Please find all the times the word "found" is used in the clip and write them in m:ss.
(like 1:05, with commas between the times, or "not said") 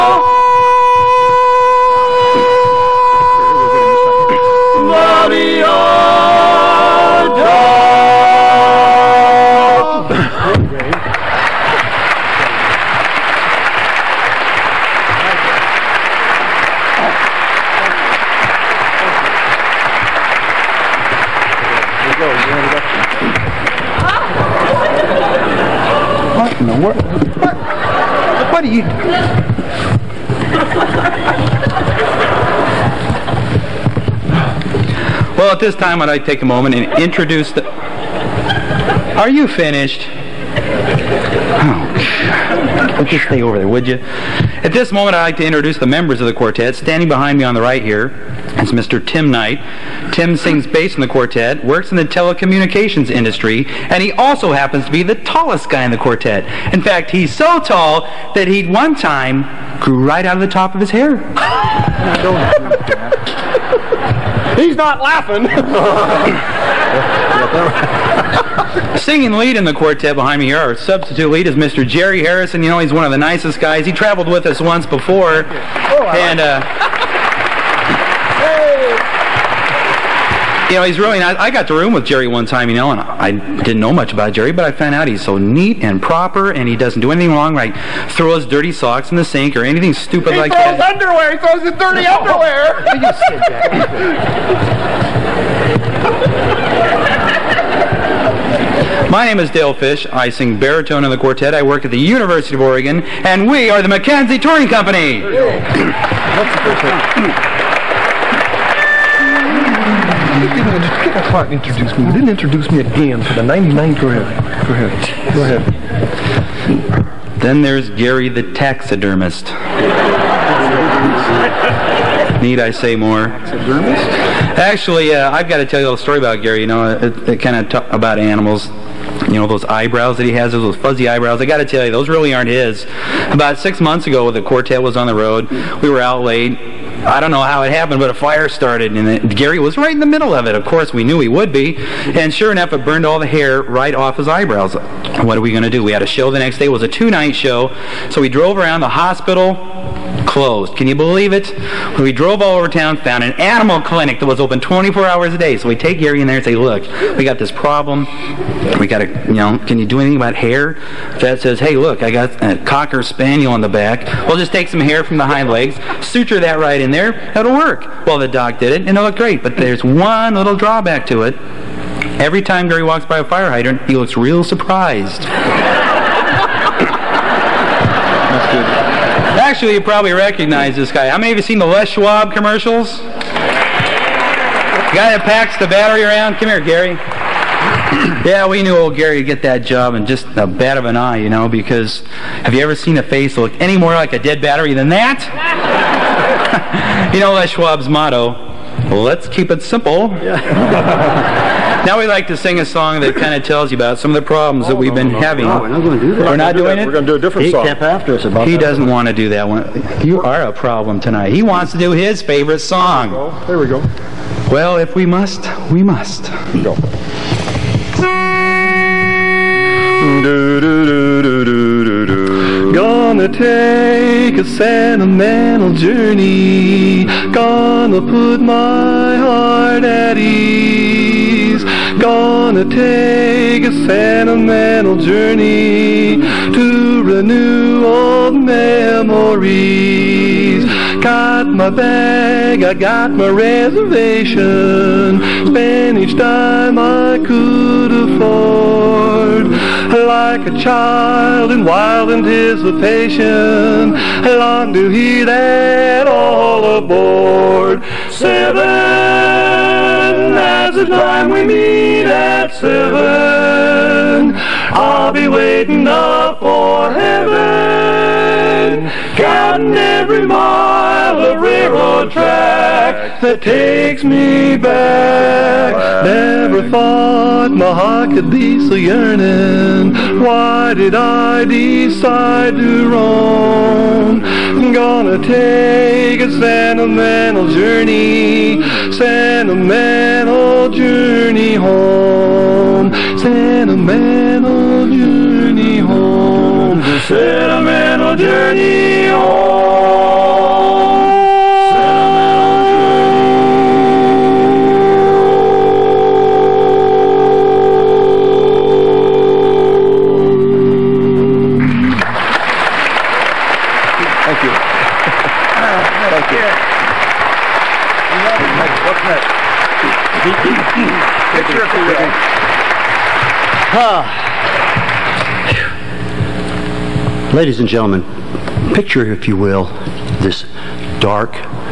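1:24, 2:32.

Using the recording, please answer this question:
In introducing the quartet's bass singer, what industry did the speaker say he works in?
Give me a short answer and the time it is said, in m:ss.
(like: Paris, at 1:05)
Telecommunications, at 0:52.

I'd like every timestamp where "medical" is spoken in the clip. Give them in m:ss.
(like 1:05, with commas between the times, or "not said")
not said.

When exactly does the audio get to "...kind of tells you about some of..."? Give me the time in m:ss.
3:23.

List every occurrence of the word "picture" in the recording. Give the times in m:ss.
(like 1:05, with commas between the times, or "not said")
5:20, 5:28.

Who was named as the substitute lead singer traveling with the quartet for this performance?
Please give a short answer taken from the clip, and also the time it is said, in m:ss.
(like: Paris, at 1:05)
Jerry Harrison, at 1:11.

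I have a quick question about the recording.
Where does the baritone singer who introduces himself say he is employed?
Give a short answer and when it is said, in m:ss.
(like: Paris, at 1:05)
University of Oregon, at 1:41.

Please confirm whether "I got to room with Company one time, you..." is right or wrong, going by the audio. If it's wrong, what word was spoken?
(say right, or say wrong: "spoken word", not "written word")
wrong: "Jerry", not "Company".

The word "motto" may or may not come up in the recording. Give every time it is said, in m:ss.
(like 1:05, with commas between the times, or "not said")
3:17.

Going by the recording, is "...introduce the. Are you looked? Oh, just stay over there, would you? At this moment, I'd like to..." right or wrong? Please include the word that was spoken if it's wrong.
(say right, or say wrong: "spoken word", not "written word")
wrong: "finished", not "looked".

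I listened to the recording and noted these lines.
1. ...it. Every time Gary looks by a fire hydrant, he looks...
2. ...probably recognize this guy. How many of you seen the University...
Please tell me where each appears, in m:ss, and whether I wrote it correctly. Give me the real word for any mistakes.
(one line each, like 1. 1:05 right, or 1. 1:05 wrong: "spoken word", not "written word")
1. 2:51 wrong: "walks", not "looks"
2. 2:59 wrong: "Les", not "University".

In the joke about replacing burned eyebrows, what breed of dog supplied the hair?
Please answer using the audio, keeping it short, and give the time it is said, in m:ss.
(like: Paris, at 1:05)
Cocker spaniel, at 2:42.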